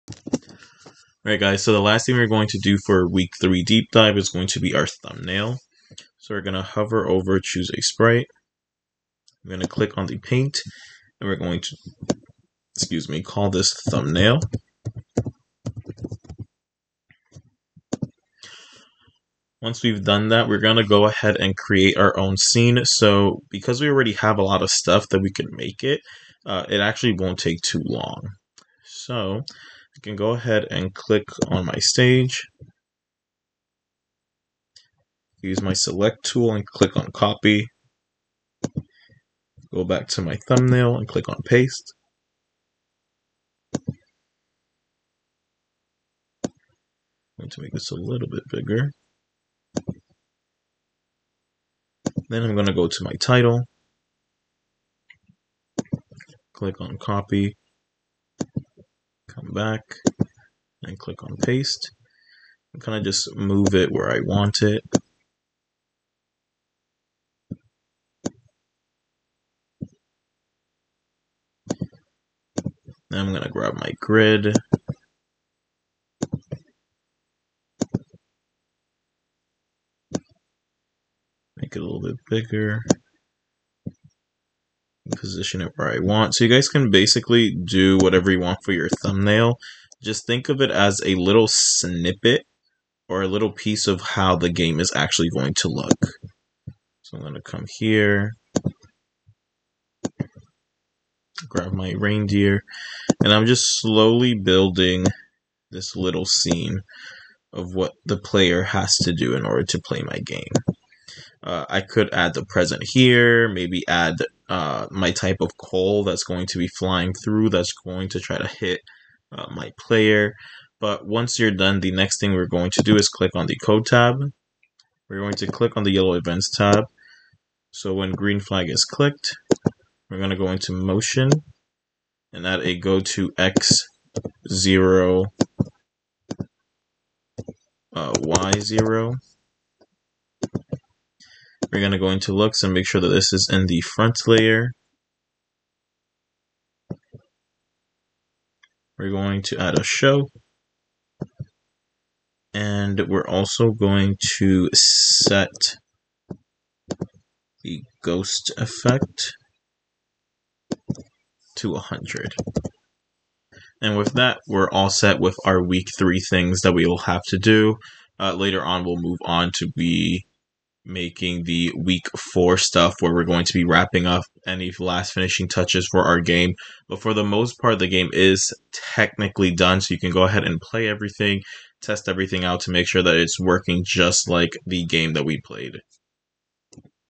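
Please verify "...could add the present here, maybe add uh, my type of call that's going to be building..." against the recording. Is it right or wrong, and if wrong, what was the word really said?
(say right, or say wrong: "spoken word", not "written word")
wrong: "flying", not "building".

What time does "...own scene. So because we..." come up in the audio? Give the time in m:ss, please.
0:22.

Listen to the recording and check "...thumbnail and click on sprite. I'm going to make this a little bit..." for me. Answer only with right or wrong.
wrong.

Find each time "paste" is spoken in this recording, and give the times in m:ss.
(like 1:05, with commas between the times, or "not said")
0:41, 1:01.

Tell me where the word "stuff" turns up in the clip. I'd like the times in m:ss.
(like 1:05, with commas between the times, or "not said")
0:24, 2:52.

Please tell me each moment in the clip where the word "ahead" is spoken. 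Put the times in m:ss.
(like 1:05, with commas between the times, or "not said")
0:21, 0:30, 3:00.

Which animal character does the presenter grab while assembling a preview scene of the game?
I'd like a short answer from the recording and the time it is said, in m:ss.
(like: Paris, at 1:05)
reindeer, at 1:41.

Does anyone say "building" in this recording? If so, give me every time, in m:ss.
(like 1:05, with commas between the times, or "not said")
1:44.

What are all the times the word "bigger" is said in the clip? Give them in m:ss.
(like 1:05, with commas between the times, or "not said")
0:48, 1:22.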